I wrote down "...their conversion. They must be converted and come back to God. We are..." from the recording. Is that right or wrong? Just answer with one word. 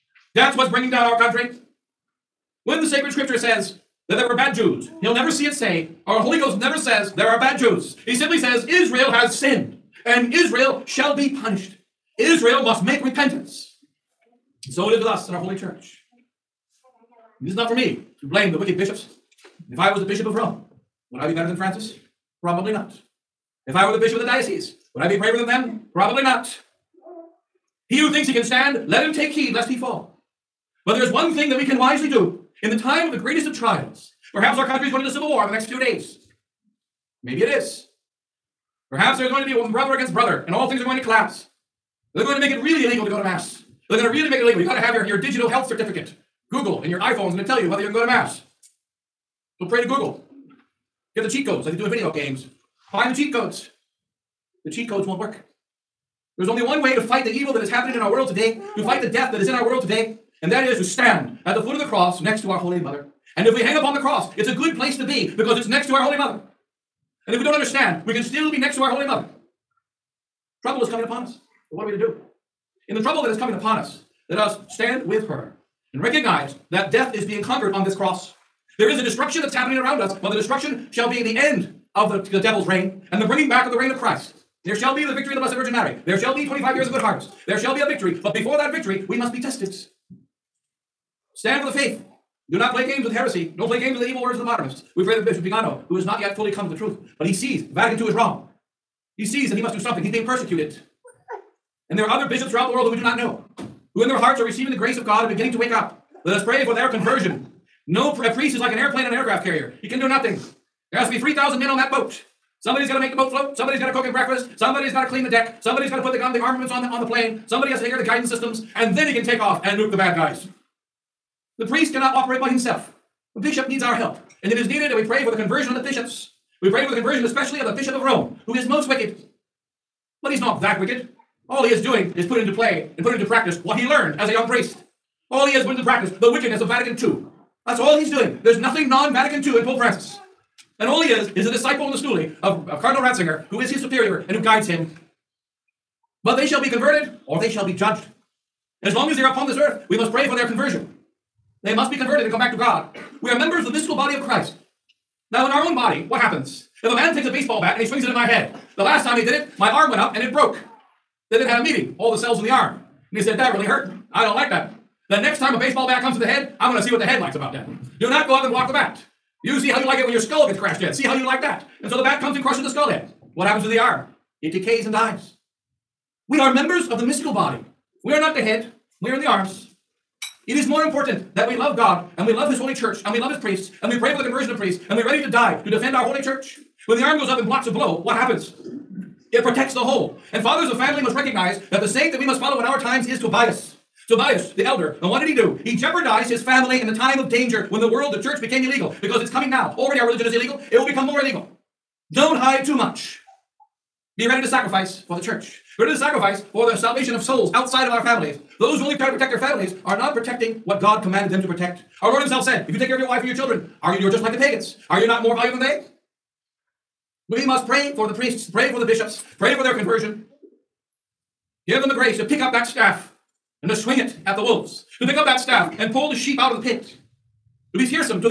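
right.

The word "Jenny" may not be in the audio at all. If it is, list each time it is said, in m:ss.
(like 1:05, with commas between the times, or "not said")
not said.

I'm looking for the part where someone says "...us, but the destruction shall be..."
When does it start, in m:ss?
1:19.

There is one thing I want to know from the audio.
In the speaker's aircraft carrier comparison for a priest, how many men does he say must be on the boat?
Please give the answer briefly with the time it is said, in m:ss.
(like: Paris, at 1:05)
3,000, at 1:51.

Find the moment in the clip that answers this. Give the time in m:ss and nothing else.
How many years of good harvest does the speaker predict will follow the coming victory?
1:26.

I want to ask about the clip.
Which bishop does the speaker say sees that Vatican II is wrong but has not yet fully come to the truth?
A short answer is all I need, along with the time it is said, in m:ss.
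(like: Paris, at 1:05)
Bishop Vigano, at 1:35.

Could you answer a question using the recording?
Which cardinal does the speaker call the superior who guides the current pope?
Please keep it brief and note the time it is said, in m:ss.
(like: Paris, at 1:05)
Cardinal Ratzinger, at 2:22.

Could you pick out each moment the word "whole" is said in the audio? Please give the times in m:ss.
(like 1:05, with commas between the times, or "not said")
3:09.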